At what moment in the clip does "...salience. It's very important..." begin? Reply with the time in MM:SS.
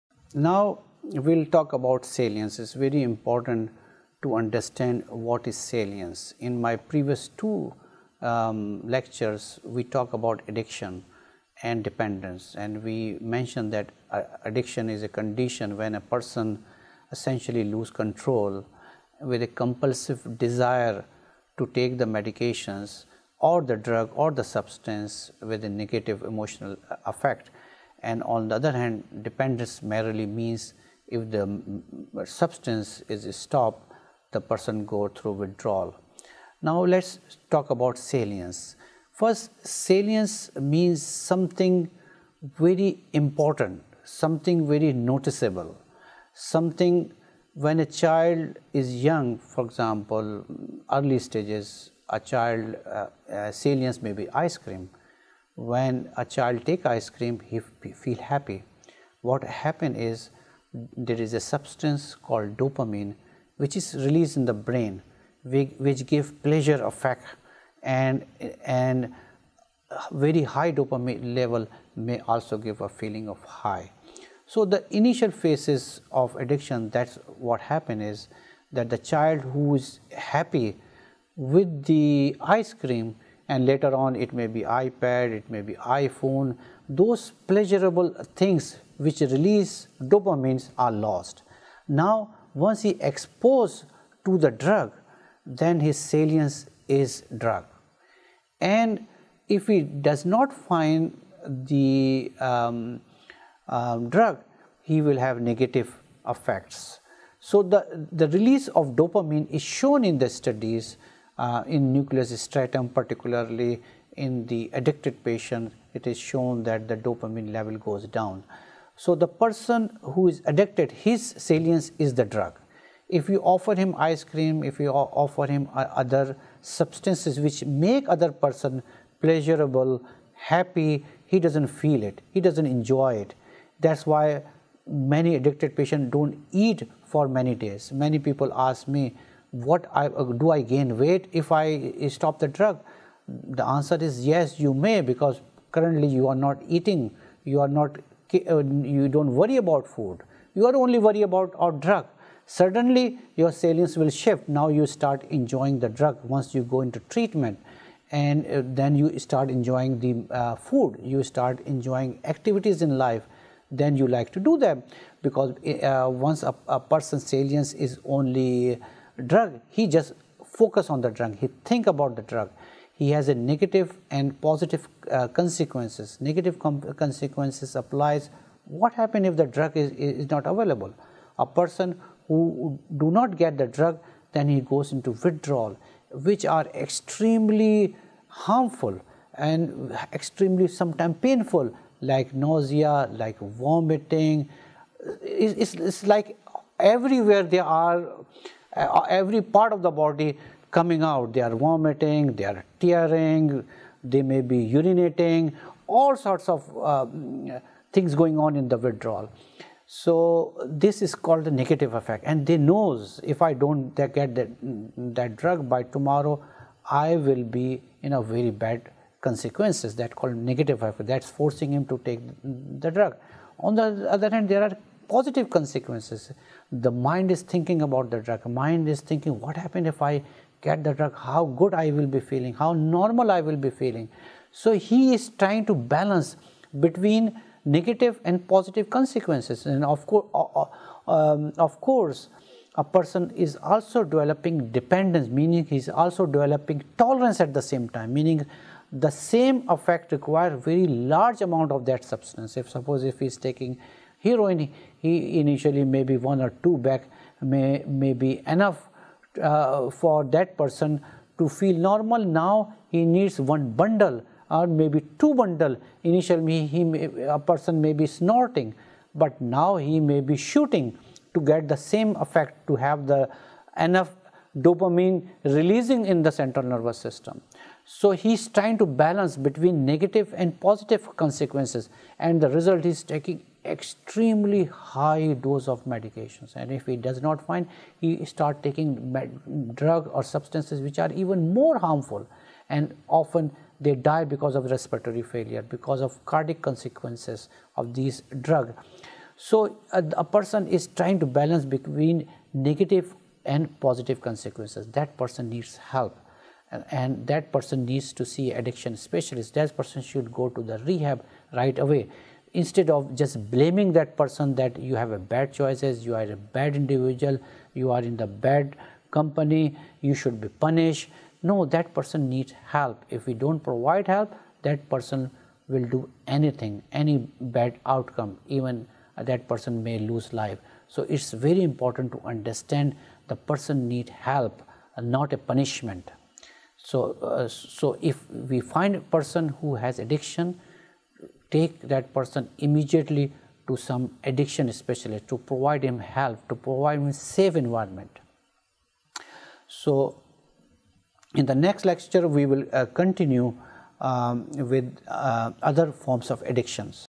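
00:02.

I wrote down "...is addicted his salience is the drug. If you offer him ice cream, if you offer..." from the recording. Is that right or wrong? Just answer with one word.
right.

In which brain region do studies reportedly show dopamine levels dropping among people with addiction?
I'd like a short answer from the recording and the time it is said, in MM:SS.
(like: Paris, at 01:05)
Nucleus striatum, at 01:51.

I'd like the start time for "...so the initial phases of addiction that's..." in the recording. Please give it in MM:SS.
01:14.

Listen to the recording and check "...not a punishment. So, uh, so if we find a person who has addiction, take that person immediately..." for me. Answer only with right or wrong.
right.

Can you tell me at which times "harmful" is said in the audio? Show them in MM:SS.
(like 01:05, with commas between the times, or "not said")
03:08, 04:51.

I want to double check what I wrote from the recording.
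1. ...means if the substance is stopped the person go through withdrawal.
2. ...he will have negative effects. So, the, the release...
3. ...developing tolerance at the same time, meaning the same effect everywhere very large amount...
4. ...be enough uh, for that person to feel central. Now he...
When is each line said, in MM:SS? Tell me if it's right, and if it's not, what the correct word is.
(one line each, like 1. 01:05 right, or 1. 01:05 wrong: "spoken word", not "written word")
1. 00:30 right
2. 01:44 right
3. 04:06 wrong: "require", not "everywhere"
4. 04:18 wrong: "normal", not "central".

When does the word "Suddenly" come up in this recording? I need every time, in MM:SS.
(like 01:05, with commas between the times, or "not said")
02:32.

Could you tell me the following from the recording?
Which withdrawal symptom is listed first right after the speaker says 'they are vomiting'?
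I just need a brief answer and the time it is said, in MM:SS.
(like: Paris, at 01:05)
Tearing, at 03:22.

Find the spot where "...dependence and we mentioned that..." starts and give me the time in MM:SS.
00:11.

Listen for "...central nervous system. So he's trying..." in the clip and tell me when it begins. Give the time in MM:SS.
04:36.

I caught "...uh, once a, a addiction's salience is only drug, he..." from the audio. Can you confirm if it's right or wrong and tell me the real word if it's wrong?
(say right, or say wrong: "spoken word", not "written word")
wrong: "person", not "addiction".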